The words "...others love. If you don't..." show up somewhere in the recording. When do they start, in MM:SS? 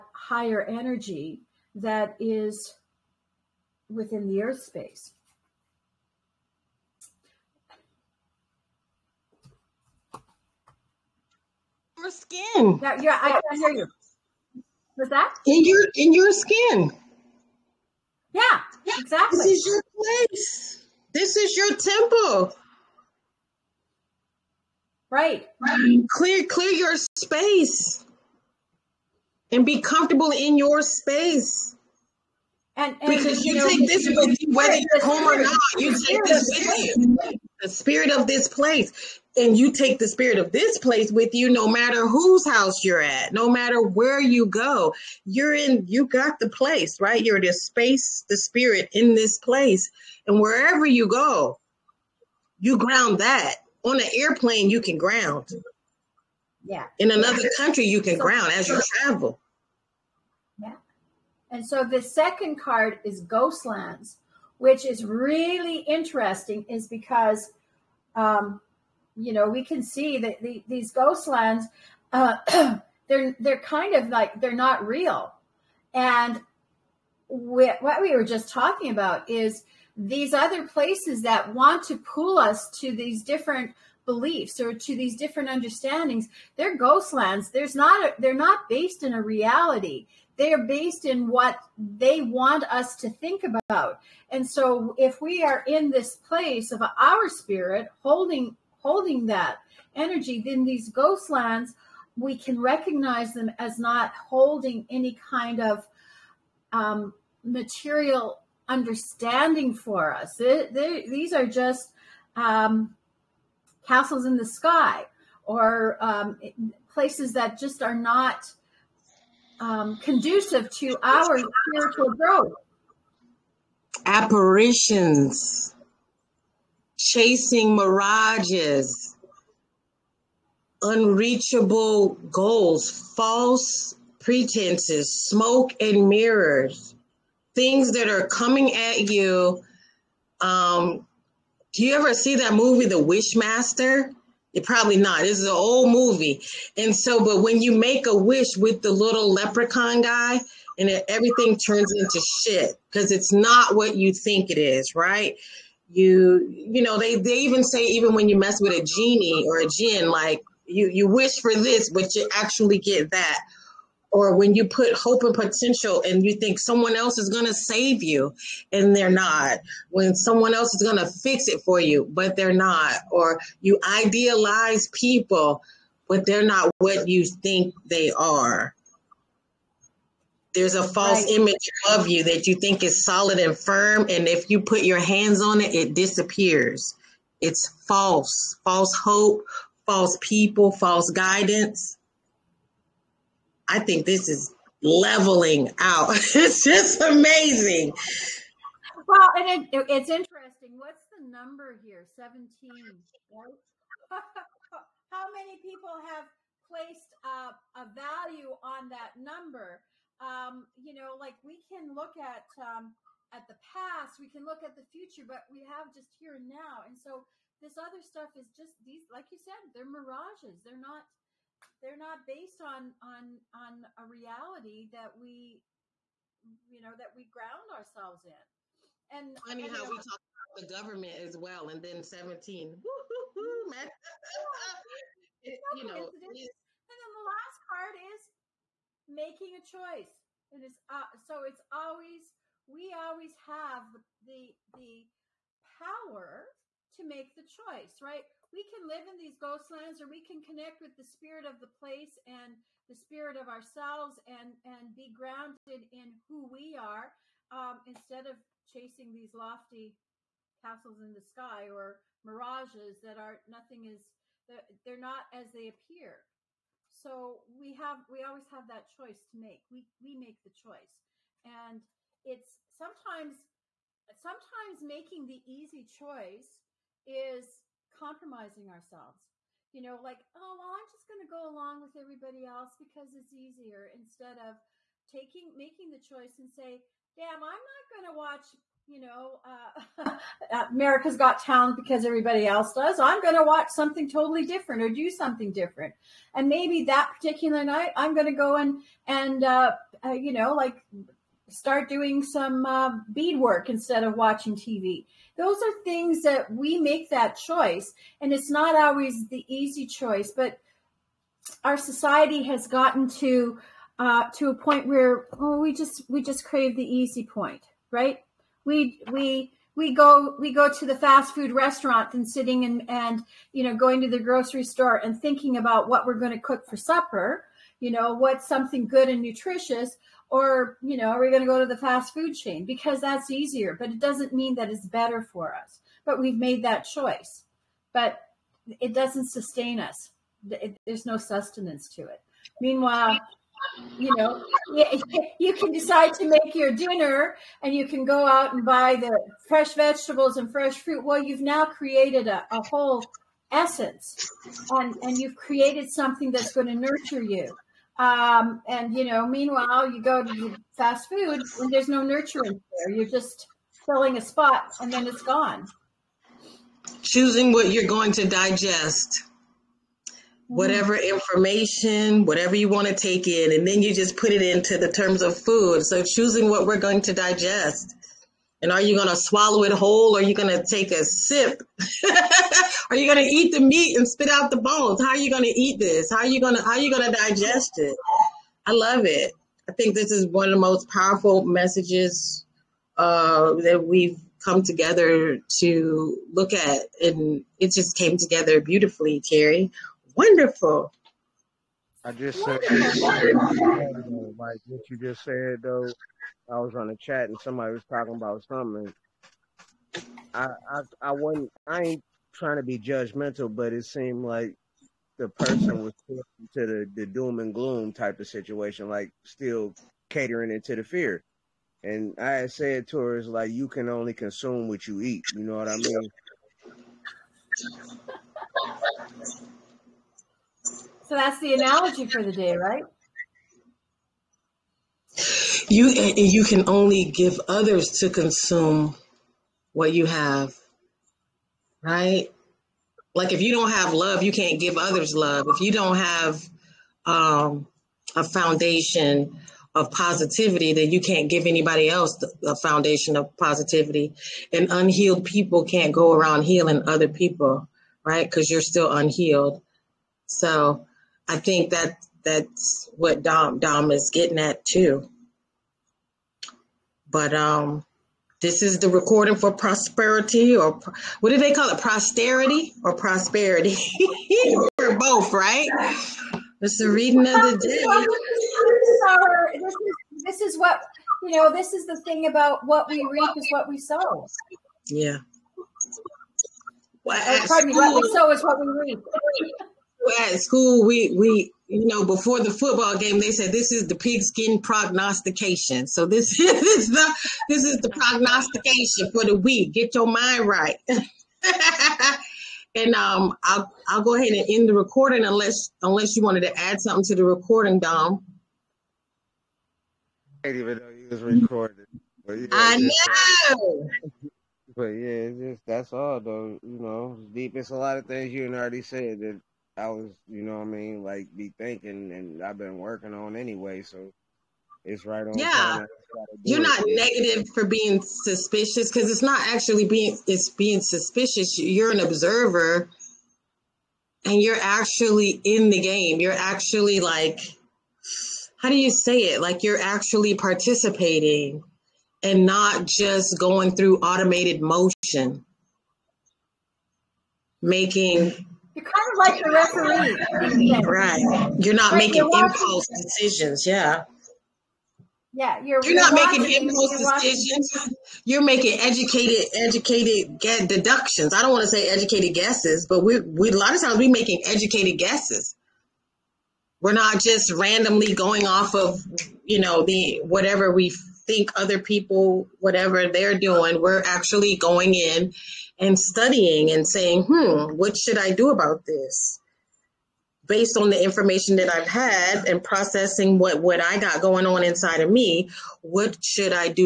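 07:24.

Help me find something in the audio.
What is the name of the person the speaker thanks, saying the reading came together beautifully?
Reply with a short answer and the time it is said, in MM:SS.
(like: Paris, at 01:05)
Terri, at 06:39.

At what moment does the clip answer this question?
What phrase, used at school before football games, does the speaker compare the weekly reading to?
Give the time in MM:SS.
08:13.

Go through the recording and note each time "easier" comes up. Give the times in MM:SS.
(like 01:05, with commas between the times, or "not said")
04:43, 05:33.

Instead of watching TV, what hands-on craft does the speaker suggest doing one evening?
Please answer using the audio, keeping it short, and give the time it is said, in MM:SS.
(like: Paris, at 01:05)
Bead work, at 05:03.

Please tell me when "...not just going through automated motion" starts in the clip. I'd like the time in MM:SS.
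09:02.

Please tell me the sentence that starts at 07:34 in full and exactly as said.
And unhealed people can't go around healing other people, right?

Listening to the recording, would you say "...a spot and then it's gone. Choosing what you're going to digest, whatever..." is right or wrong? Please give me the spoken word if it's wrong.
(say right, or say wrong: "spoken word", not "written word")
right.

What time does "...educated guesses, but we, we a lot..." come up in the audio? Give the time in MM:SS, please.
09:21.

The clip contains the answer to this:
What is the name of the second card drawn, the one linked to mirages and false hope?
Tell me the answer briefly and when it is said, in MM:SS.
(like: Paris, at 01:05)
Ghostlands, at 01:03.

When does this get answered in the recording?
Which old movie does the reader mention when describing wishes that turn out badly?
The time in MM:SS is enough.
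02:22.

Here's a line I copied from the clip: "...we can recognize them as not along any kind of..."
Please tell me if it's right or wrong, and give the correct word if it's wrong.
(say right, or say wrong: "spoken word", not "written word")
wrong: "holding", not "along".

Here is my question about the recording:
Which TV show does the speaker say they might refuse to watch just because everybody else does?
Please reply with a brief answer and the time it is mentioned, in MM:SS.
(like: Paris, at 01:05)
America's Got Talent, at 04:50.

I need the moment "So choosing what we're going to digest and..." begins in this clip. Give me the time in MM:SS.
06:15.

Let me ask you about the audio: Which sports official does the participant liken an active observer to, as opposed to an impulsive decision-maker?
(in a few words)
The referee.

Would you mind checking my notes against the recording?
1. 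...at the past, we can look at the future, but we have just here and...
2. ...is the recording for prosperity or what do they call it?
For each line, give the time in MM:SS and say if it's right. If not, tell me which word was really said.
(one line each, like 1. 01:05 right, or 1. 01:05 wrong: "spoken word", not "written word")
1. 03:33 right
2. 07:48 right.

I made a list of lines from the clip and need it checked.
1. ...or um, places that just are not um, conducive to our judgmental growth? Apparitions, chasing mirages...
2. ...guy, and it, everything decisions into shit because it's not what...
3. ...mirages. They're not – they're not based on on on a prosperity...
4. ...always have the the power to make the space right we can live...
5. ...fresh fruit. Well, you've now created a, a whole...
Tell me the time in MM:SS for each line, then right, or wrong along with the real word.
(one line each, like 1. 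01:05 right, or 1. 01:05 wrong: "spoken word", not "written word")
1. 01:55 wrong: "spiritual", not "judgmental"
2. 02:30 wrong: "turns", not "decisions"
3. 03:39 wrong: "reality", not "prosperity"
4. 04:02 wrong: "choice", not "space"
5. 05:50 right.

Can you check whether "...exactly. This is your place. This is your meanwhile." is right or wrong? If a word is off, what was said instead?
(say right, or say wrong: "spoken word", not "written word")
wrong: "temple", not "meanwhile".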